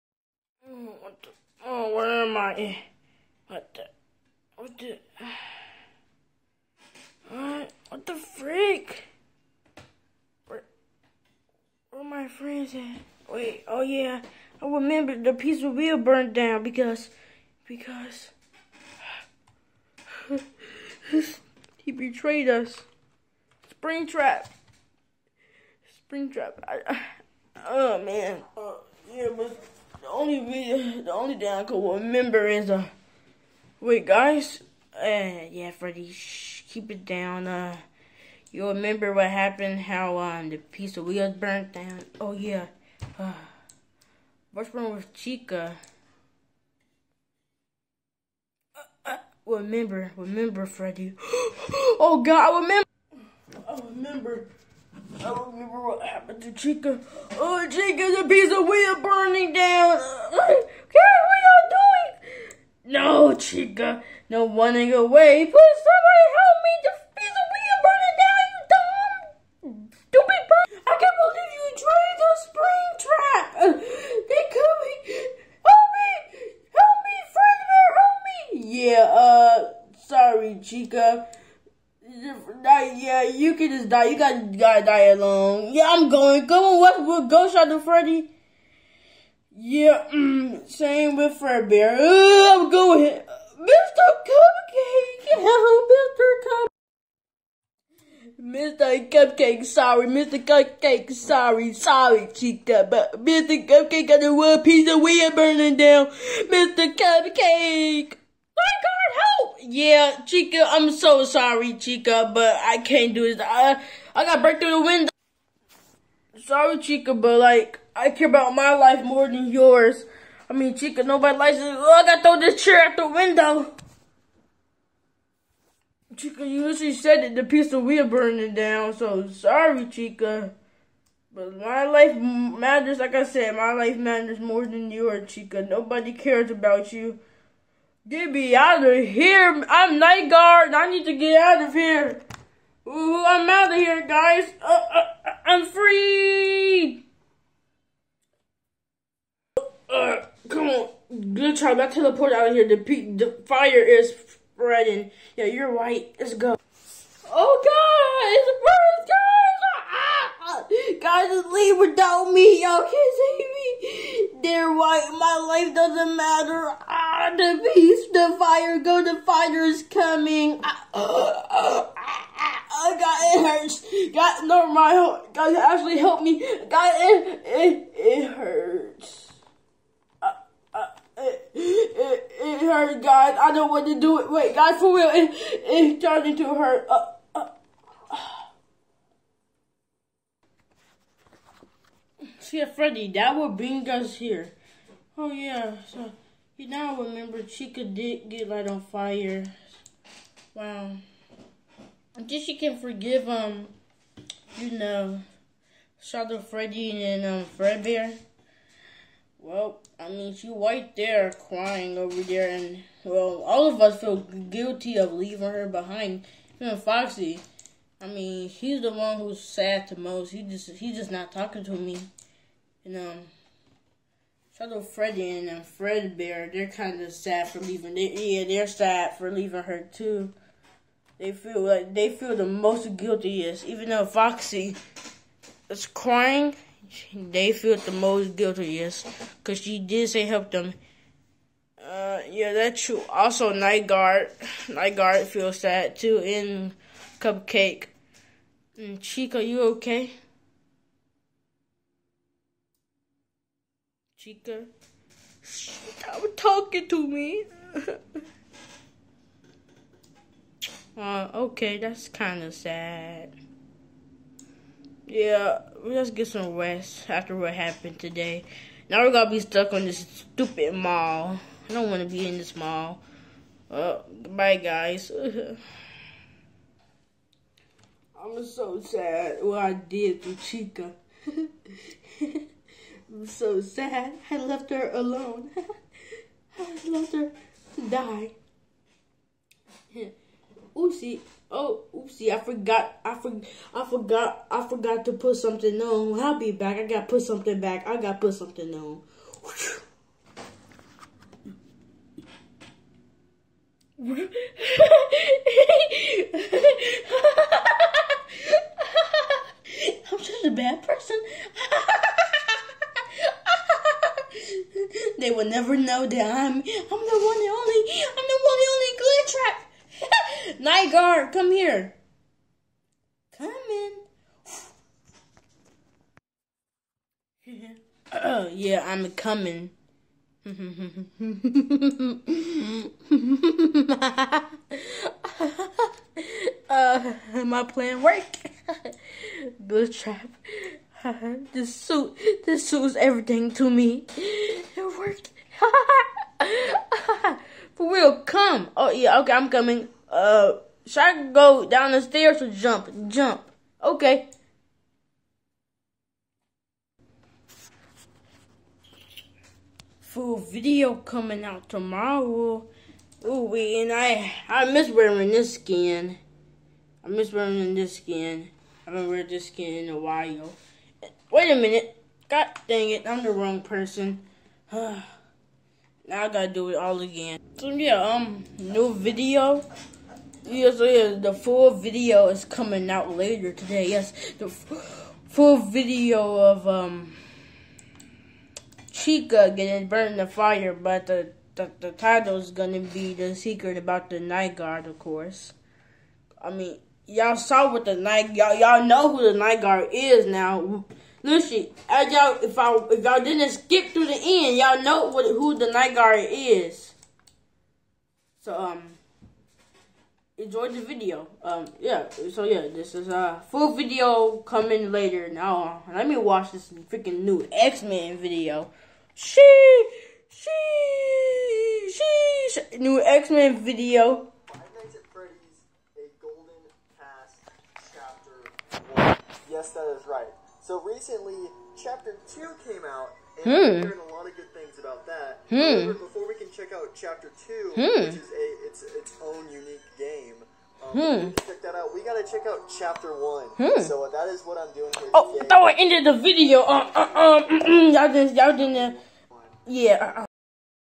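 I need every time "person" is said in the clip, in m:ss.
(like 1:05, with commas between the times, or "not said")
5:10, 6:13.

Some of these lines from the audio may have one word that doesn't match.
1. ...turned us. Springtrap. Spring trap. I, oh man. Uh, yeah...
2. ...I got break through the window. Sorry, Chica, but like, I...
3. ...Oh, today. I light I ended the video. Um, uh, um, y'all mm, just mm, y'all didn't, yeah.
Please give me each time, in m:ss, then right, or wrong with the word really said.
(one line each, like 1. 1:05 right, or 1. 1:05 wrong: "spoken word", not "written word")
1. 0:21 wrong: "betrayed", not "turned"
2. 1:54 right
3. 7:25 wrong: "thought", not "light".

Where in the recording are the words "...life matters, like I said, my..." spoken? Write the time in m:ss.
2:11.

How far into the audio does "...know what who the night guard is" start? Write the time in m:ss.
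6:44.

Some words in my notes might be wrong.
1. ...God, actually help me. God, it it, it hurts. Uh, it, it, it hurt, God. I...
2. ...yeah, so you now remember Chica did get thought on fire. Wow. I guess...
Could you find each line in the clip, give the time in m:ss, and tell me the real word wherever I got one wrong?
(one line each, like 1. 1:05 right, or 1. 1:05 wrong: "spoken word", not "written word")
1. 2:55 right
2. 3:15 wrong: "light", not "thought".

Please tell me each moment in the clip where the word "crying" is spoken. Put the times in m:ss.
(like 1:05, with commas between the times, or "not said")
3:31, 3:55.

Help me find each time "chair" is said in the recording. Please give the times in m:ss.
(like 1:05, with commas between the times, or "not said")
2:02.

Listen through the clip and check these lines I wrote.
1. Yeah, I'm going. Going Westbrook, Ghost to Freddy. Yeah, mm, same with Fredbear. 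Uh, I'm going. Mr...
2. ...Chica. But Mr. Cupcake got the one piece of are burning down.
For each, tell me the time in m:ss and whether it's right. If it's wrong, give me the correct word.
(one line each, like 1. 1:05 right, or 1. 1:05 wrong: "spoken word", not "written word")
1. 1:25 right
2. 1:42 right.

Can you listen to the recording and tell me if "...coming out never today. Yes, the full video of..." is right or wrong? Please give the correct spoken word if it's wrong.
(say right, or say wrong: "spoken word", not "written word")
wrong: "later", not "never".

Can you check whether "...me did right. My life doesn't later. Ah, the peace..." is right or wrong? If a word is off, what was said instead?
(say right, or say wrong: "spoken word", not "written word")
wrong: "matter", not "later".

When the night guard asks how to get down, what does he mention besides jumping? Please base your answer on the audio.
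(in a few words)
stairs.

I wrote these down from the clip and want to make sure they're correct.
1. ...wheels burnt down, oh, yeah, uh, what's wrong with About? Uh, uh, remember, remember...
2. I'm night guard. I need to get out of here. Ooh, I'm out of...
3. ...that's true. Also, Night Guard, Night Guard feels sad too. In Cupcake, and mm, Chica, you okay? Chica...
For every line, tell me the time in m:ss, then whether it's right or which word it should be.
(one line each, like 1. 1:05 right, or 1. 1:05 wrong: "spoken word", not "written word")
1. 0:41 wrong: "Chica", not "About"
2. 2:19 right
3. 4:02 right.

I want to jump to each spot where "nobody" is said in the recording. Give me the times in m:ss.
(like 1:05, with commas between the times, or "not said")
2:01, 2:15.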